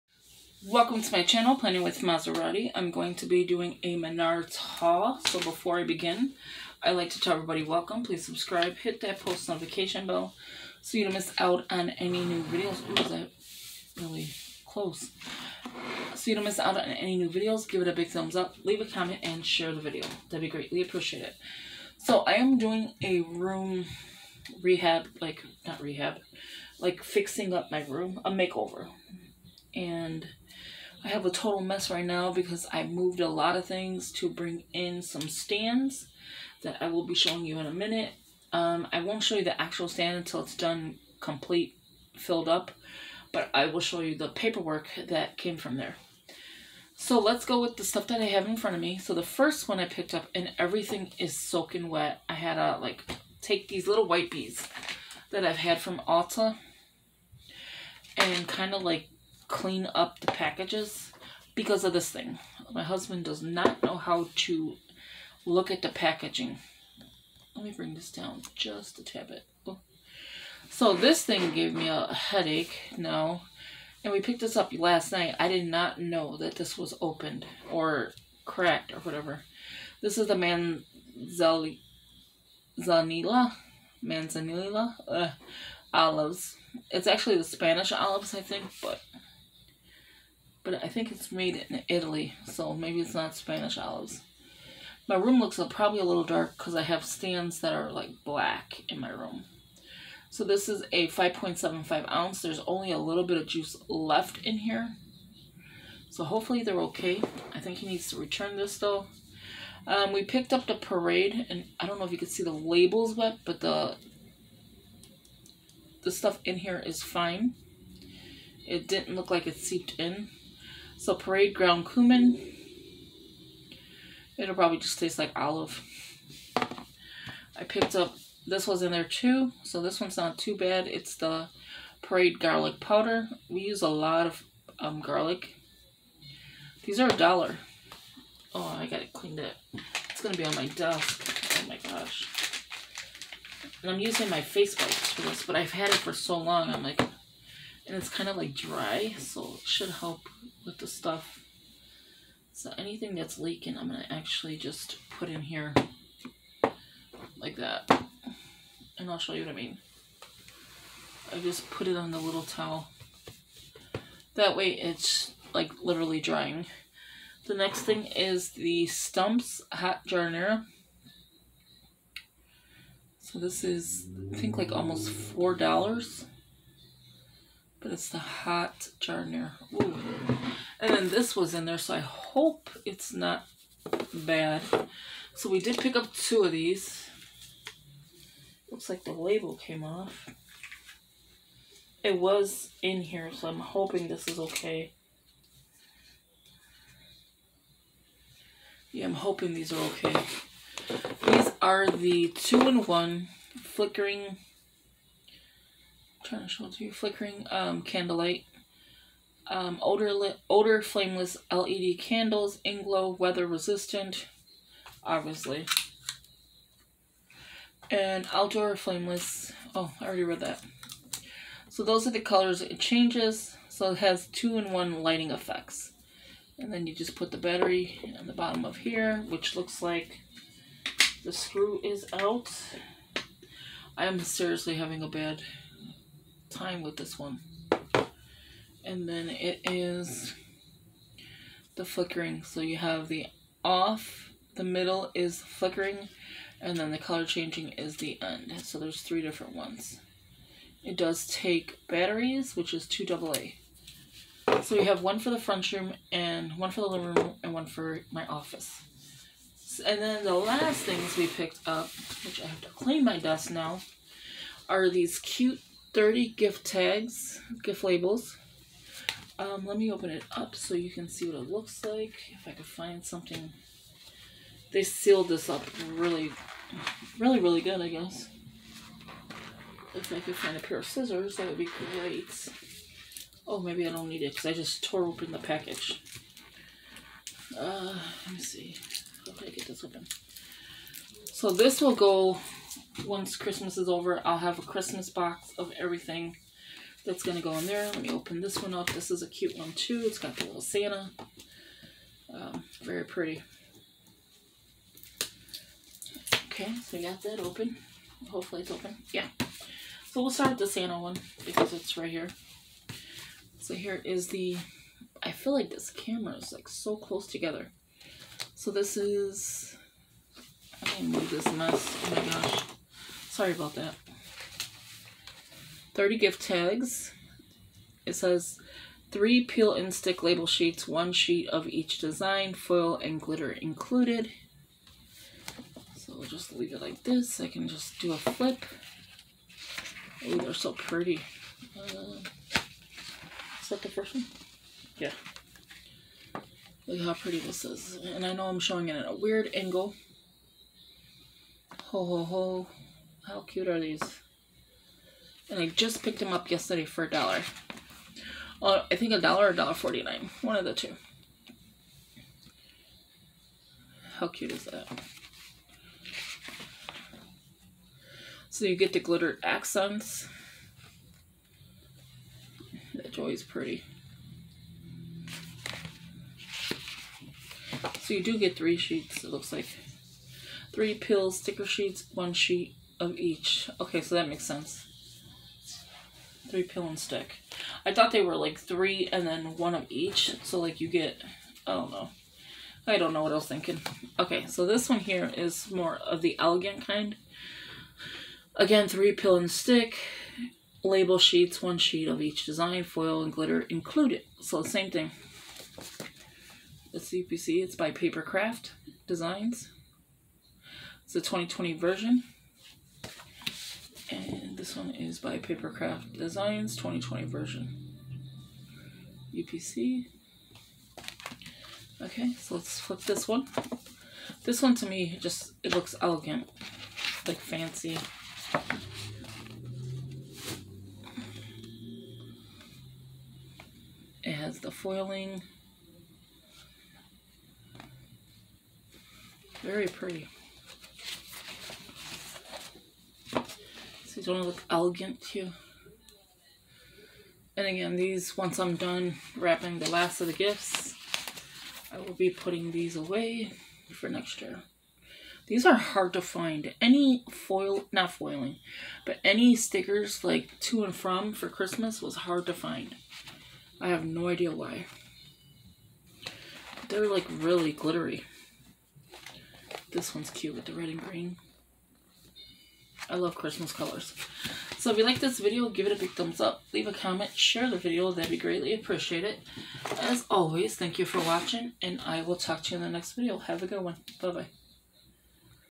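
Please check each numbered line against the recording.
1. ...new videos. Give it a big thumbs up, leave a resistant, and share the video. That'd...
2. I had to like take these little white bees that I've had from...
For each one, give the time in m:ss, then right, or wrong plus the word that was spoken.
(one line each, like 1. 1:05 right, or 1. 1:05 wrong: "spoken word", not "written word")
1. 0:17 wrong: "comment", not "resistant"
2. 0:52 right.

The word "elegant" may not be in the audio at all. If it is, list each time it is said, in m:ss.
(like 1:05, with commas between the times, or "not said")
6:36, 7:05, 7:24.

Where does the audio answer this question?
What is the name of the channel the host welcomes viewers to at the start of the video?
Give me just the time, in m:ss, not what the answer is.
0:01.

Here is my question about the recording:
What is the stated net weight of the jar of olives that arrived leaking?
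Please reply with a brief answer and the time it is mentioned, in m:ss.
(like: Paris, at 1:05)
5.75 ounces, at 1:41.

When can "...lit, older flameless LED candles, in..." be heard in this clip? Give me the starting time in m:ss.
3:30.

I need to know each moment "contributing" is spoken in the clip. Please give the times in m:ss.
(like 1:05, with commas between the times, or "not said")
not said.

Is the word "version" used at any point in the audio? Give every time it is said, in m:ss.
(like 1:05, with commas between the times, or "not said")
6:51, 6:57.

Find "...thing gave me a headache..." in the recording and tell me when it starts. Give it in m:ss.
1:11.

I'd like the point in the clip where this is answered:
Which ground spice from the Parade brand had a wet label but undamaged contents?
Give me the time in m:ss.
2:01.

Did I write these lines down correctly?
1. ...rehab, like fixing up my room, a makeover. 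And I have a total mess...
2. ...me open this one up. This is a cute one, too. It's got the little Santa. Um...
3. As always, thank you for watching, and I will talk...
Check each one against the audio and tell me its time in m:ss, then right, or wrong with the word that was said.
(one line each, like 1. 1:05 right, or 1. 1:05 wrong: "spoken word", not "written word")
1. 0:25 right
2. 4:58 right
3. 7:59 right.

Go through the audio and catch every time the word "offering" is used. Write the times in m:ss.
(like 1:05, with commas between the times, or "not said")
not said.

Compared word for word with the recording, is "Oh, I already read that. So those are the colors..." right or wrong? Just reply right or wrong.
right.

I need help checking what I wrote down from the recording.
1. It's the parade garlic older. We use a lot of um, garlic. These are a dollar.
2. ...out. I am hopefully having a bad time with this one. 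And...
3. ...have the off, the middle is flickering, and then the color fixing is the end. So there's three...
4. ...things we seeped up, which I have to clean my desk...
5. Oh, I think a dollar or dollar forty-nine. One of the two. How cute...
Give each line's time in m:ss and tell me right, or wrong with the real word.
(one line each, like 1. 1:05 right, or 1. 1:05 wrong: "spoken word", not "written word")
1. 2:10 wrong: "powder", not "older"
2. 3:52 wrong: "seriously", not "hopefully"
3. 4:02 wrong: "changing", not "fixing"
4. 4:20 wrong: "picked", not "seeped"
5. 5:58 right.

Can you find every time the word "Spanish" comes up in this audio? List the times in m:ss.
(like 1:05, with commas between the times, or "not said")
1:27, 1:33.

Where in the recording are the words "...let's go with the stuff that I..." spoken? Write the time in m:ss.
0:47.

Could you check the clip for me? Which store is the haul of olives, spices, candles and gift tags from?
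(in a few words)
Menards.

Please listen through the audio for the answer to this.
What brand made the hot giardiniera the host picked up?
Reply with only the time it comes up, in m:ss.
2:48.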